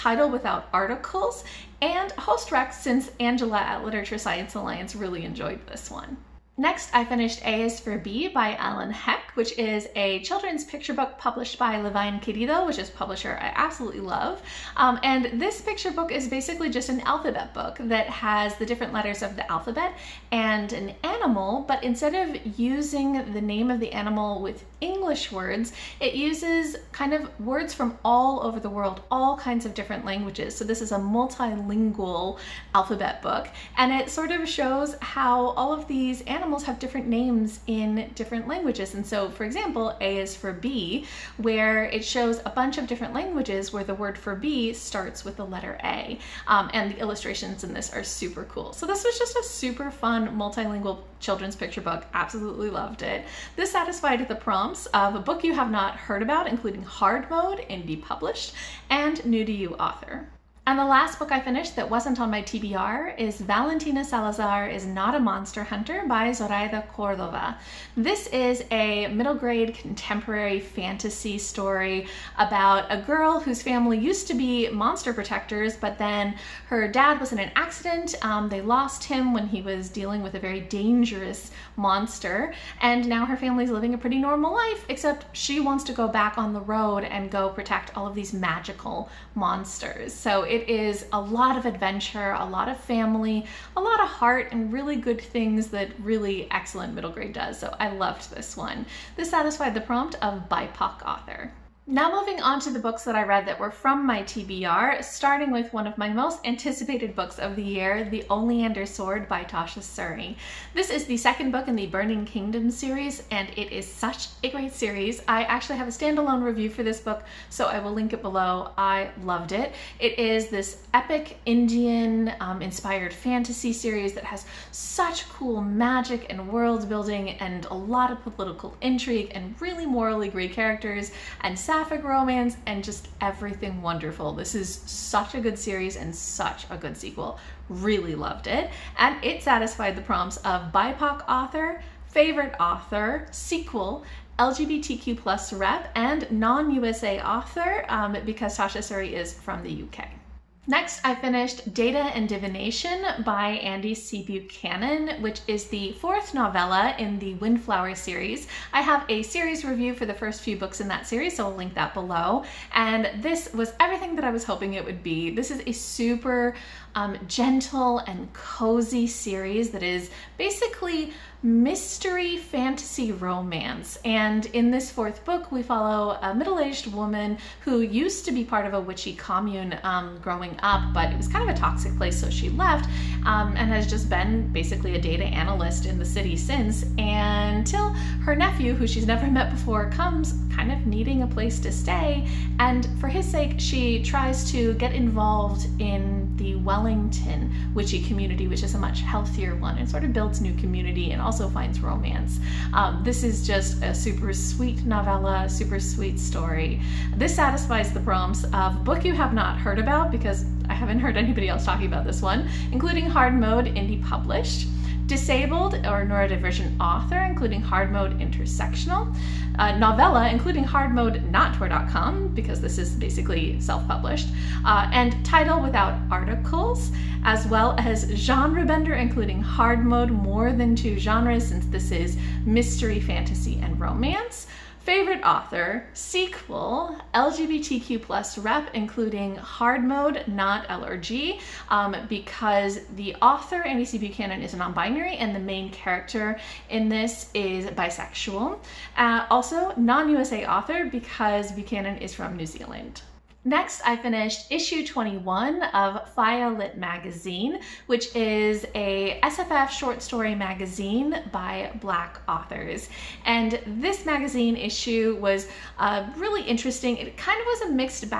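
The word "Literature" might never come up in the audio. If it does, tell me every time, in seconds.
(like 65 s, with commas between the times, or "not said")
3 s.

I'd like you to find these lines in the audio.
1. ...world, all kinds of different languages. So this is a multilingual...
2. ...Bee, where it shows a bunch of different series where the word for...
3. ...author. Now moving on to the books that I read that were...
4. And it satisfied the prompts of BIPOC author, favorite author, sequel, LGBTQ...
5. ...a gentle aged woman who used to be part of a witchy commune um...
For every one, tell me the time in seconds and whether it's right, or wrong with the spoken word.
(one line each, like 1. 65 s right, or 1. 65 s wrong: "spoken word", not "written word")
1. 28 s right
2. 40 s wrong: "languages", not "series"
3. 101 s right
4. 138 s right
5. 176 s wrong: "middle", not "gentle".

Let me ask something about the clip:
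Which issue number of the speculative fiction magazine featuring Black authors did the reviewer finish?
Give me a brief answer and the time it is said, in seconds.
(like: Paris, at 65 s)
21, at 254 s.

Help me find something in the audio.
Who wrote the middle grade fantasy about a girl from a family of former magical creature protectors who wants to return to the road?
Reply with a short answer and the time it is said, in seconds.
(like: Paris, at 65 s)
Zoraida Cordova, at 66 s.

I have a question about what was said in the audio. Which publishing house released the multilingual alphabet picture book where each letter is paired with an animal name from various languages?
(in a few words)
Levine Querido.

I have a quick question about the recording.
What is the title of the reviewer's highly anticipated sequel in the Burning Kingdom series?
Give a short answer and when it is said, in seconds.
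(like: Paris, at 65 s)
The Oleander Sword, at 108 s.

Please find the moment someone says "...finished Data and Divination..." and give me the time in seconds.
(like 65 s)
151 s.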